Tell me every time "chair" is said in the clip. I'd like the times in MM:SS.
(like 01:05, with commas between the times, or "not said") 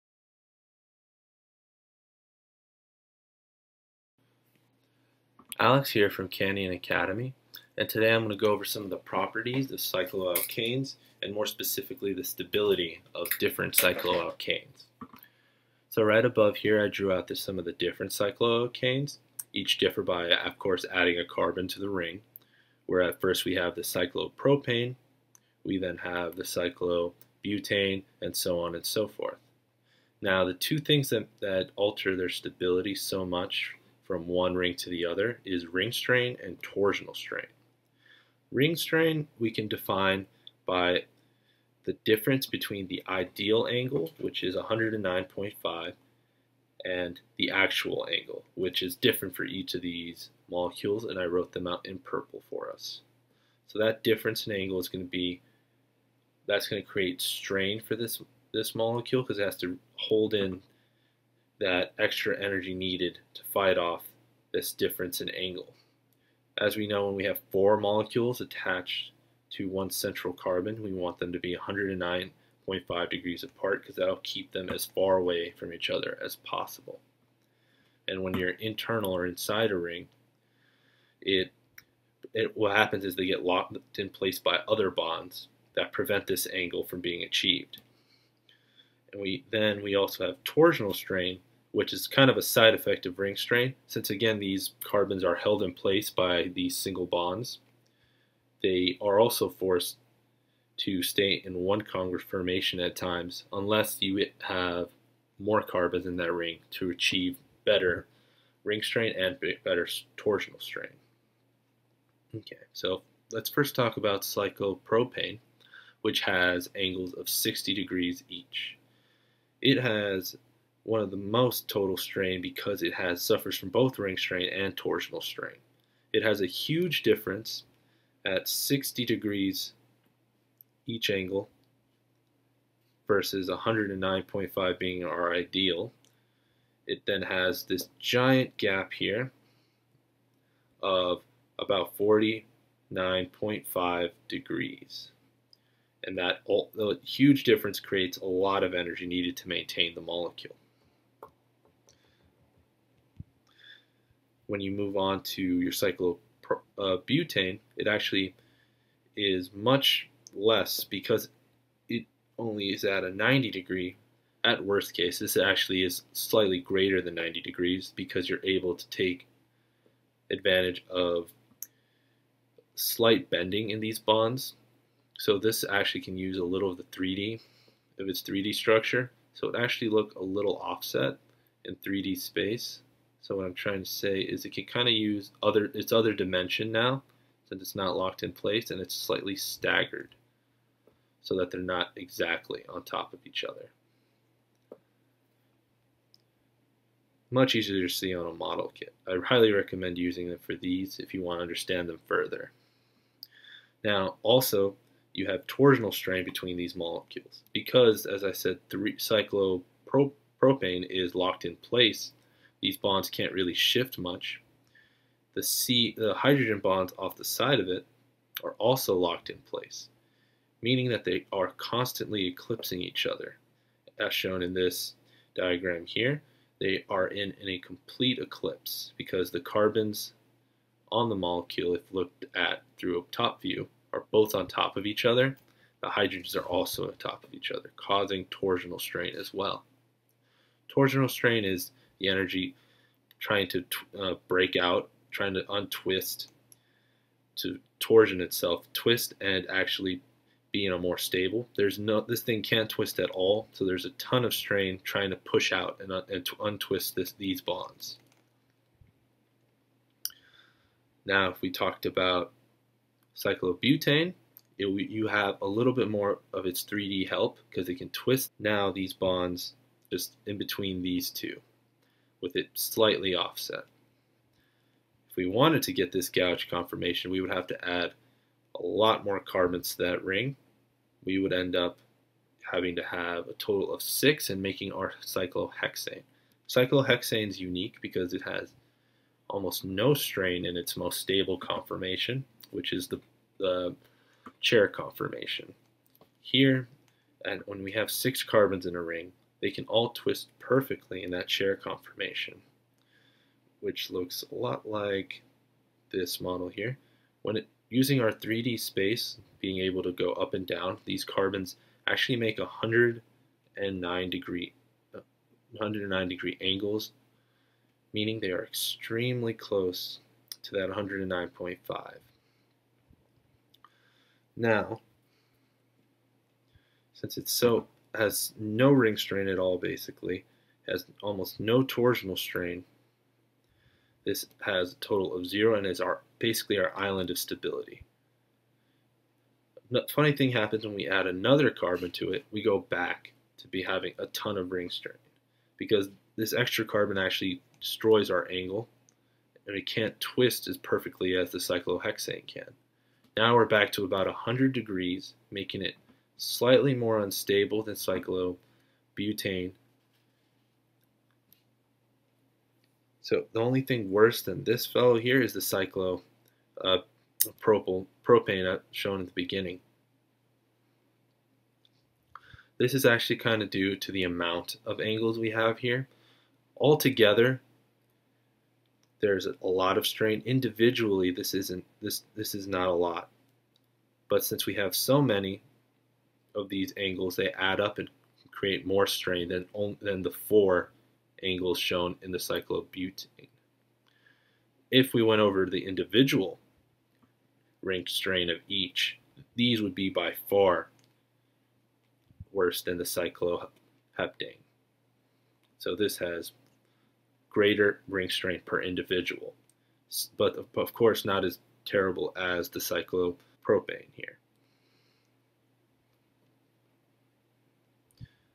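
04:54, 05:01.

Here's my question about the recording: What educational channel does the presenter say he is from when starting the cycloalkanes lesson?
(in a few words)
Canyon Academy.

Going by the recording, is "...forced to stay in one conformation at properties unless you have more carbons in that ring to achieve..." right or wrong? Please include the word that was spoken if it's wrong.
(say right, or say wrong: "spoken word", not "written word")
wrong: "times", not "properties".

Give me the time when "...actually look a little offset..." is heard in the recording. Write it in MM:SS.
02:59.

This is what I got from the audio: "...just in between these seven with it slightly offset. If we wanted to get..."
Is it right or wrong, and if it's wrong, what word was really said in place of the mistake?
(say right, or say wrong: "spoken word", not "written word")
wrong: "two", not "seven".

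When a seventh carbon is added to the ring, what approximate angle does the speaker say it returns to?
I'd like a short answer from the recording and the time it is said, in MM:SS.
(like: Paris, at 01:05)
100 degrees, at 05:54.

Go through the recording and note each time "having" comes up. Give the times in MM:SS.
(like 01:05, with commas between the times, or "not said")
04:42, 05:43.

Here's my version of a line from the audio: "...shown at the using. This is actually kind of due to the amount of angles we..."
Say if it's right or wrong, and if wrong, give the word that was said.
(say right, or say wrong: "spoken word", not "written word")
wrong: "beginning", not "using".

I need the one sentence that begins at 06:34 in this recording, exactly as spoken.
If we went over the individual ranked strain of each, these would be by far worse than the cycloheptane.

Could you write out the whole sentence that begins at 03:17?
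Much easier to see on a model kit.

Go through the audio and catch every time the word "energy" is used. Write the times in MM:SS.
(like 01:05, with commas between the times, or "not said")
01:02, 02:28, 04:02.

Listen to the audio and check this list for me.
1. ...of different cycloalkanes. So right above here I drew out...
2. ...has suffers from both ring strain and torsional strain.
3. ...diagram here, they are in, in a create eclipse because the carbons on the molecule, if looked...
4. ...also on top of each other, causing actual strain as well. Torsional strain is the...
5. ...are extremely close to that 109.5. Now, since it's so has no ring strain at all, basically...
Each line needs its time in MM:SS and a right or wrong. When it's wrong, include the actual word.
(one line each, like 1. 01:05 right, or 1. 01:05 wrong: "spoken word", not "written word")
1. 00:13 right
2. 02:02 right
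3. 03:45 wrong: "complete", not "create"
4. 03:56 wrong: "torsional", not "actual"
5. 05:18 right.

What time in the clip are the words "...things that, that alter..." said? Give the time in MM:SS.
00:30.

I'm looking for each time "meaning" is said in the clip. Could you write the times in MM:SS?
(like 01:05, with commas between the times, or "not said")
03:40, 05:17.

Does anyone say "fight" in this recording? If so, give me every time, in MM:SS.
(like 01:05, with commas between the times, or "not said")
01:03.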